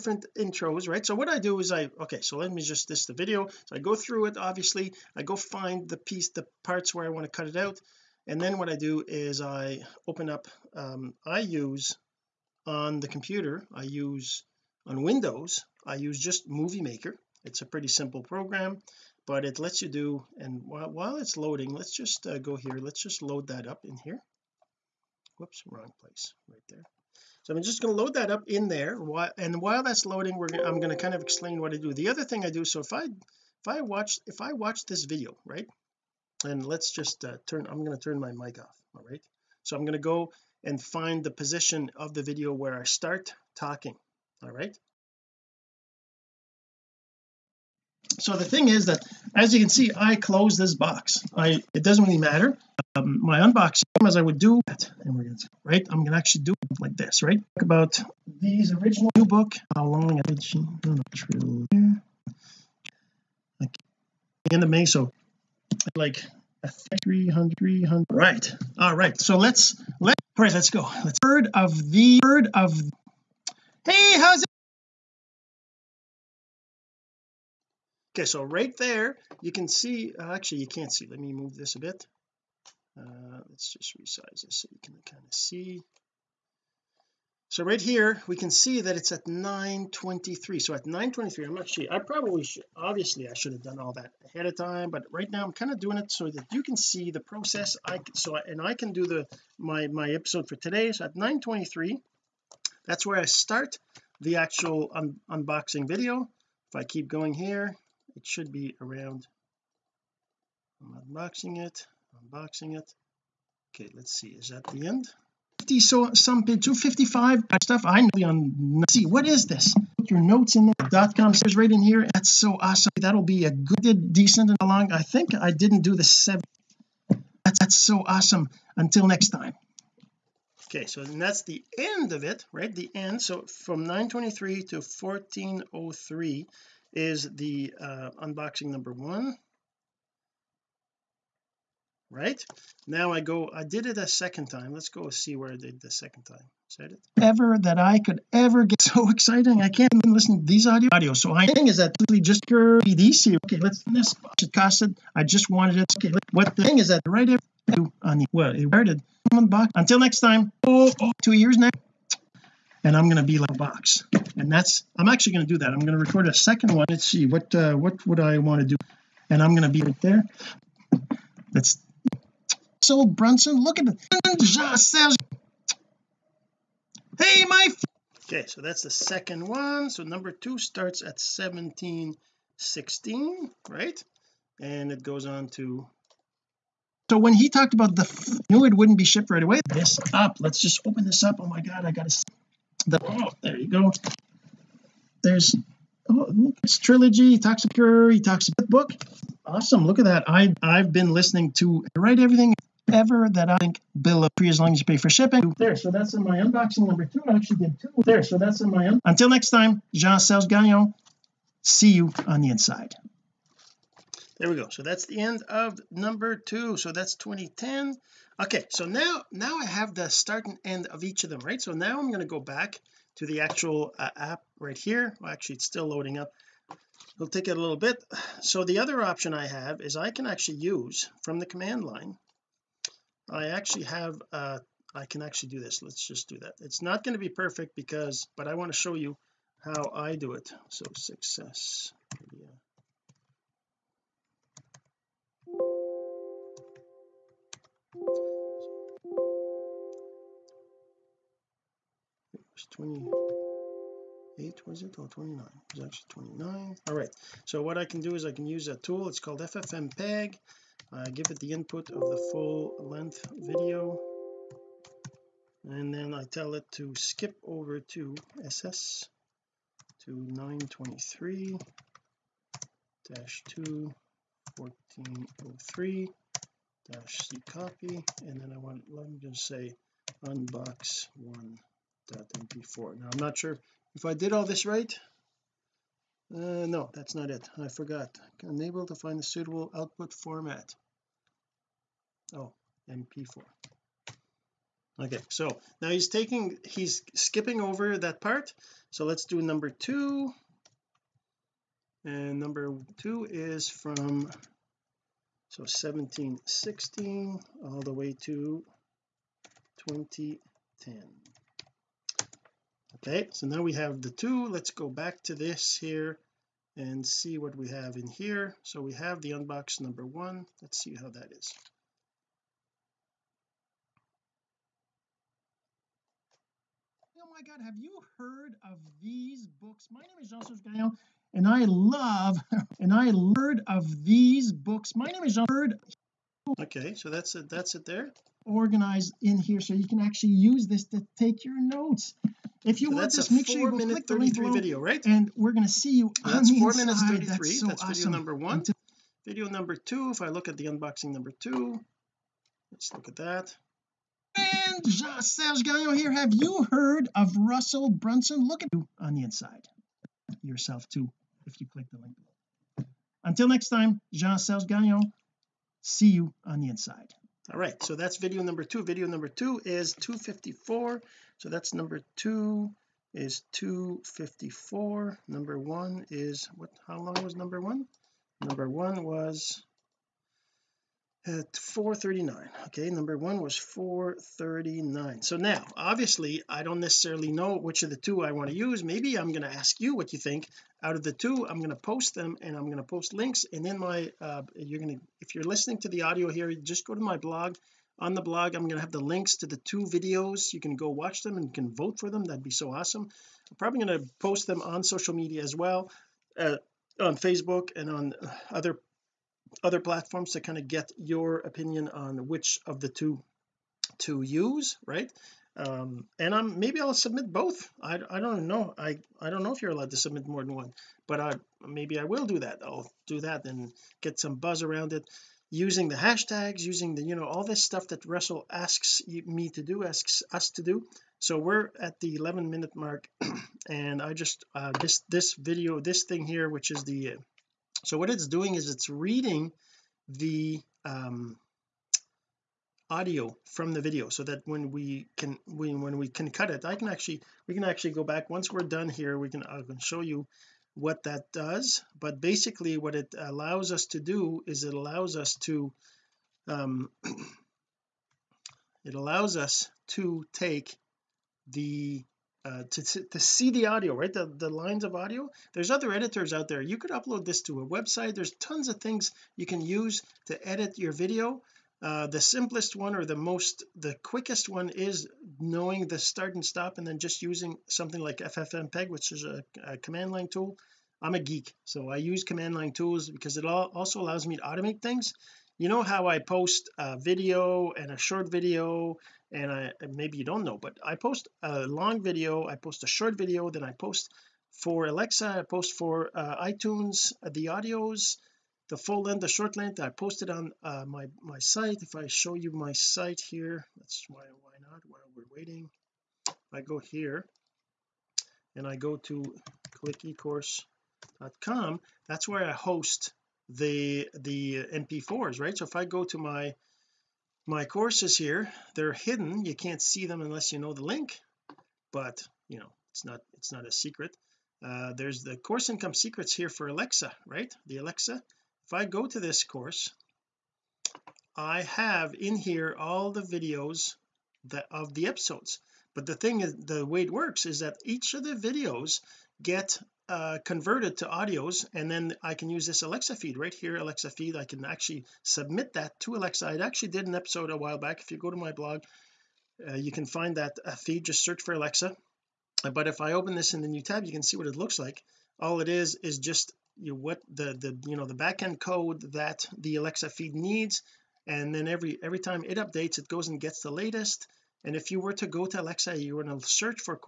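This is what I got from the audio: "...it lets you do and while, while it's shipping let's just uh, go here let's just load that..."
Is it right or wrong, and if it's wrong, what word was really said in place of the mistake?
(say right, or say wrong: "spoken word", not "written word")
wrong: "loading", not "shipping".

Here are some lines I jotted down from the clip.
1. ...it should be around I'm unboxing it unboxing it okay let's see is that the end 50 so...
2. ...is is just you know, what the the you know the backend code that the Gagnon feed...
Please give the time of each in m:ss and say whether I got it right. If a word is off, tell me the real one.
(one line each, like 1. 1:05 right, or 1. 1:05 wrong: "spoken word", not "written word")
1. 1:48 right
2. 9:15 wrong: "Alexa", not "Gagnon".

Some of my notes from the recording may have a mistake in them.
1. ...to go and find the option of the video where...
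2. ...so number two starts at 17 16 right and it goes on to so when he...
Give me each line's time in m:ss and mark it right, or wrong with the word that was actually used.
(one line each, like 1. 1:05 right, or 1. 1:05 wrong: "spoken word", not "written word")
1. 0:39 wrong: "position", not "option"
2. 2:59 right.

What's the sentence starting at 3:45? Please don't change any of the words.
Well, actually, it's still loading up.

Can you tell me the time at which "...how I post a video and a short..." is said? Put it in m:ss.
8:05.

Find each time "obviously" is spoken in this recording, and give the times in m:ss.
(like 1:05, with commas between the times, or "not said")
0:04, 1:32, 6:25.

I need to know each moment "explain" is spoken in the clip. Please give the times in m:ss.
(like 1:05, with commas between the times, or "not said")
0:31.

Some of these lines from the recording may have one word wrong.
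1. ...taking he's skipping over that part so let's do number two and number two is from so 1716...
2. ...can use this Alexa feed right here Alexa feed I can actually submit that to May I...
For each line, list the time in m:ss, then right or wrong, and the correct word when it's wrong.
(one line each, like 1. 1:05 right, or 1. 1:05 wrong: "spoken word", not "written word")
1. 4:56 right
2. 9:02 wrong: "Alexa", not "May".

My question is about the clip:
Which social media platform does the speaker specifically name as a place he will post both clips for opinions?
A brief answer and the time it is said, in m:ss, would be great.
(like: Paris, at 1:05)
Facebook, at 6:47.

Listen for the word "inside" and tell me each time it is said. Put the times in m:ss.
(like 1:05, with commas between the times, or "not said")
3:32, 5:46, 5:59, 6:06.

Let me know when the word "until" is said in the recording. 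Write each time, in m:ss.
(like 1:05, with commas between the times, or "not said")
2:08, 2:39, 3:29, 6:03.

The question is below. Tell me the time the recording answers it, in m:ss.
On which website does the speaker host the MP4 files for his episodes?
8:29.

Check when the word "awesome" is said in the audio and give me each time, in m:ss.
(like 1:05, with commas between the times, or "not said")
2:02, 2:08, 3:19, 5:47, 6:42.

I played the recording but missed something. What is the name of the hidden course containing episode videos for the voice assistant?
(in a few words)
Course Income Secrets.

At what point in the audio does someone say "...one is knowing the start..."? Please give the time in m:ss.
7:54.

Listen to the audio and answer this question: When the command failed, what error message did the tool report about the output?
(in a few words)
unable to find a suitable output format.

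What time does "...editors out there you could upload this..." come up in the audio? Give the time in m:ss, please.
7:45.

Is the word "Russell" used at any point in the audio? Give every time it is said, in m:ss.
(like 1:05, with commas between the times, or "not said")
5:57, 7:08.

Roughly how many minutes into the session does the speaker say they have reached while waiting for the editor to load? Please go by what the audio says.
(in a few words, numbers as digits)
11.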